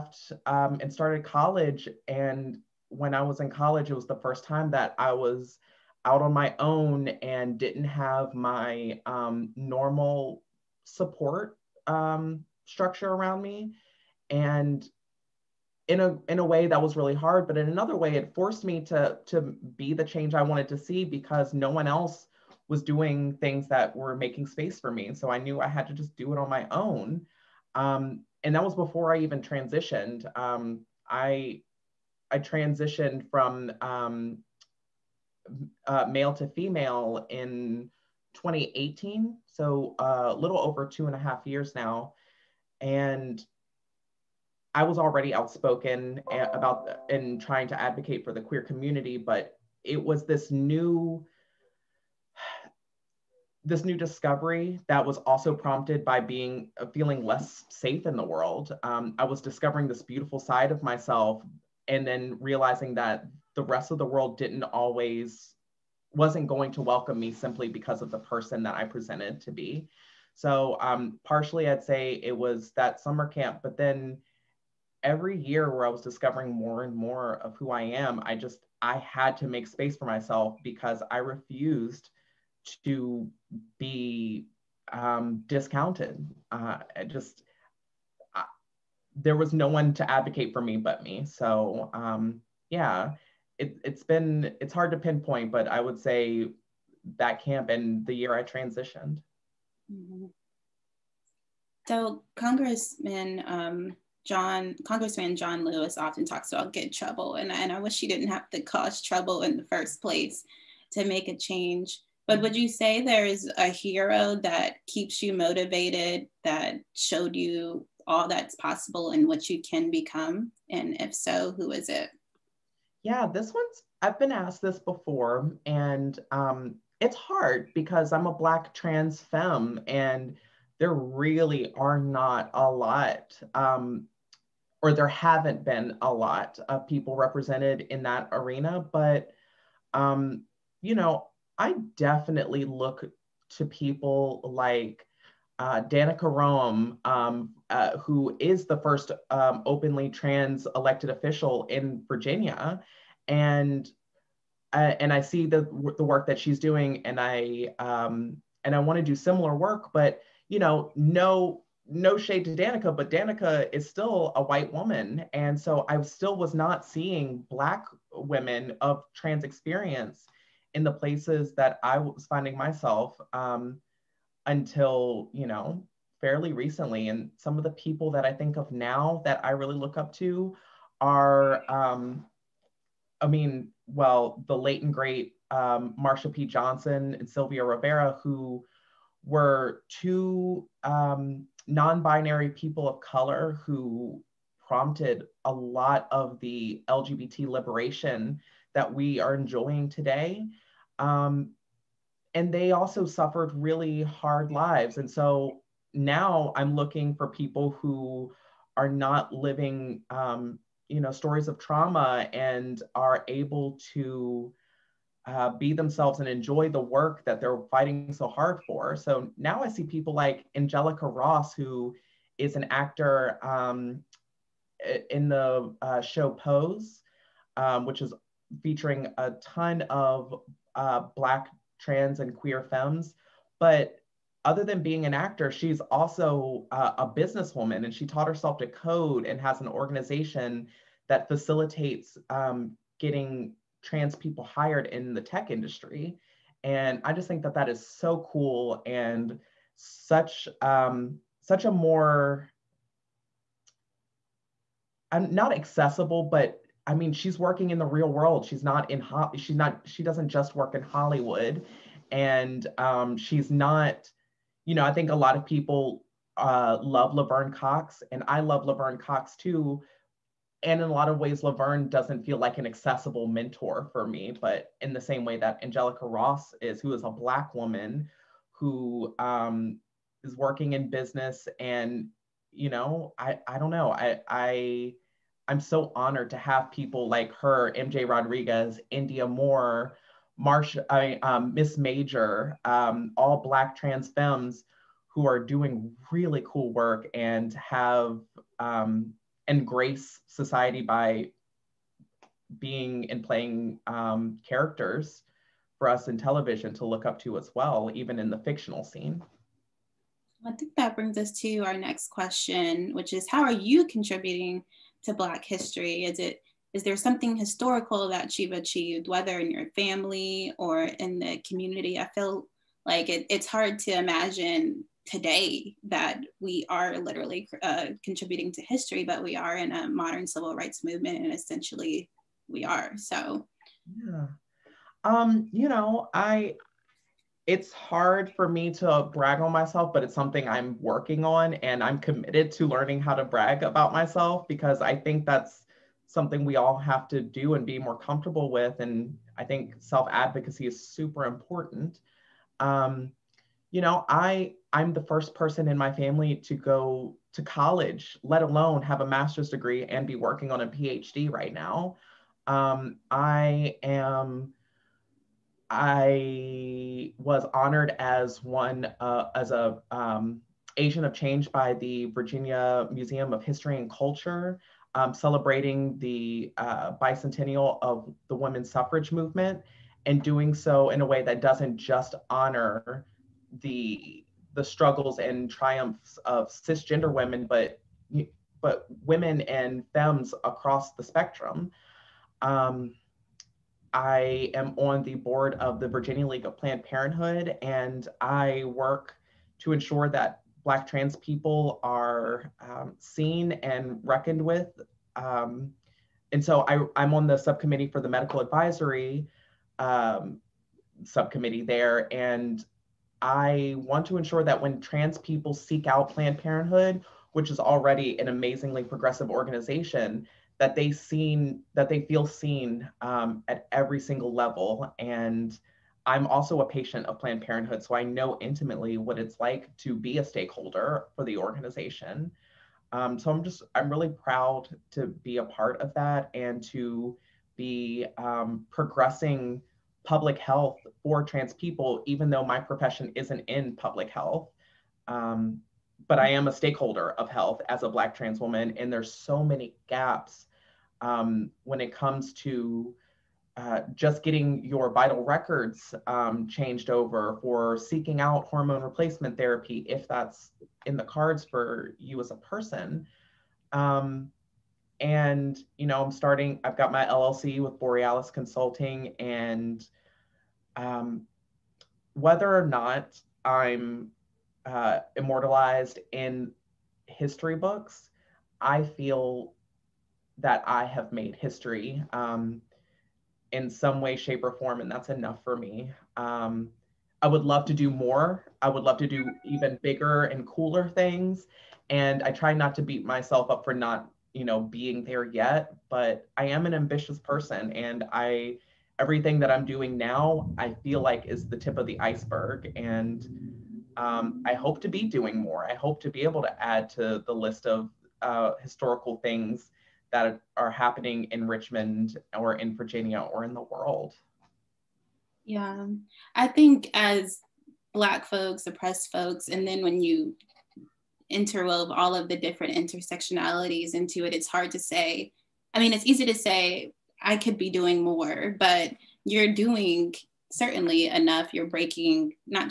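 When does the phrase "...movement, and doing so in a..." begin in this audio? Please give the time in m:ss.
6:19.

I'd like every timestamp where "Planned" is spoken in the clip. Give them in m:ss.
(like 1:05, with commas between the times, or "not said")
6:36, 6:56, 7:07.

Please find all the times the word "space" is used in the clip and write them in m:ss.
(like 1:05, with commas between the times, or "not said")
0:24, 1:19.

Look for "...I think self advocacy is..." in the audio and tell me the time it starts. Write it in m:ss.
5:49.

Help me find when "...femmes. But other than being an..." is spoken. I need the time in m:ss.
3:52.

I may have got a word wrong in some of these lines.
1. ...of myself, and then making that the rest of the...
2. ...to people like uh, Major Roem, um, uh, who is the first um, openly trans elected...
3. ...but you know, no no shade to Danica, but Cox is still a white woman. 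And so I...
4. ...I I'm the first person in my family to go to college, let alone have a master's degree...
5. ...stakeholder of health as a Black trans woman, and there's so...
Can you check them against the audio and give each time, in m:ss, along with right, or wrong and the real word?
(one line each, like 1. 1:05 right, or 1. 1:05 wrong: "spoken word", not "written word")
1. 1:00 wrong: "realizing", not "making"
2. 2:23 wrong: "Danica", not "Major"
3. 2:39 wrong: "Danica", not "Cox"
4. 5:54 right
5. 7:26 right.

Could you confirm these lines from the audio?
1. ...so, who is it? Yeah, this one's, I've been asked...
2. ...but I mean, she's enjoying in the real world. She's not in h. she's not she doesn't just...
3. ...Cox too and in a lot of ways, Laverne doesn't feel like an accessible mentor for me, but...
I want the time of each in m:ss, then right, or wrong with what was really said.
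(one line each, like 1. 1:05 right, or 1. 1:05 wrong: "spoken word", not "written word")
1. 2:01 right
2. 4:16 wrong: "working", not "enjoying"
3. 4:28 right.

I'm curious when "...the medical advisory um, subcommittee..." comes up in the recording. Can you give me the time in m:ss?
6:47.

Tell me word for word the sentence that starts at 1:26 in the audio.
Uh, just, I, there was no one to advocate for me but me.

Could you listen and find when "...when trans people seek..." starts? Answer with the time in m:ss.
6:54.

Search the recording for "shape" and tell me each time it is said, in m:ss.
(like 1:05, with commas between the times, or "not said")
8:04.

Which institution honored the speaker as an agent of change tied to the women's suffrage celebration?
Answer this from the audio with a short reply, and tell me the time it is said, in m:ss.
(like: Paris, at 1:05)
Virginia Museum of History and Culture, at 6:12.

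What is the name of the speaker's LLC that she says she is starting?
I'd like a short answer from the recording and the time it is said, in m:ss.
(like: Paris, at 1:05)
Borealis Consulting, at 7:47.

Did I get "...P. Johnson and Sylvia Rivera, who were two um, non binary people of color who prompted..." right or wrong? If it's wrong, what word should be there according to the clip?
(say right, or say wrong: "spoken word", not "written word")
right.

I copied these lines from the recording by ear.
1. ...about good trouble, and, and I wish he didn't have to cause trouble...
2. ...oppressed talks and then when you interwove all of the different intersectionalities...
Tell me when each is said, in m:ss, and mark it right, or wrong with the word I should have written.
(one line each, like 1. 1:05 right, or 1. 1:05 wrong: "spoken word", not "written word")
1. 1:46 right
2. 8:38 wrong: "folks", not "talks".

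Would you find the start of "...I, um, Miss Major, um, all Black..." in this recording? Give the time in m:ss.
4:50.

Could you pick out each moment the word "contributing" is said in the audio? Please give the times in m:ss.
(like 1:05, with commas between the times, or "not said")
5:13, 5:28.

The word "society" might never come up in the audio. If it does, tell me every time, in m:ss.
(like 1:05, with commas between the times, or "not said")
5:00.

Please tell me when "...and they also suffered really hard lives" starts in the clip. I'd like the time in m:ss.
3:22.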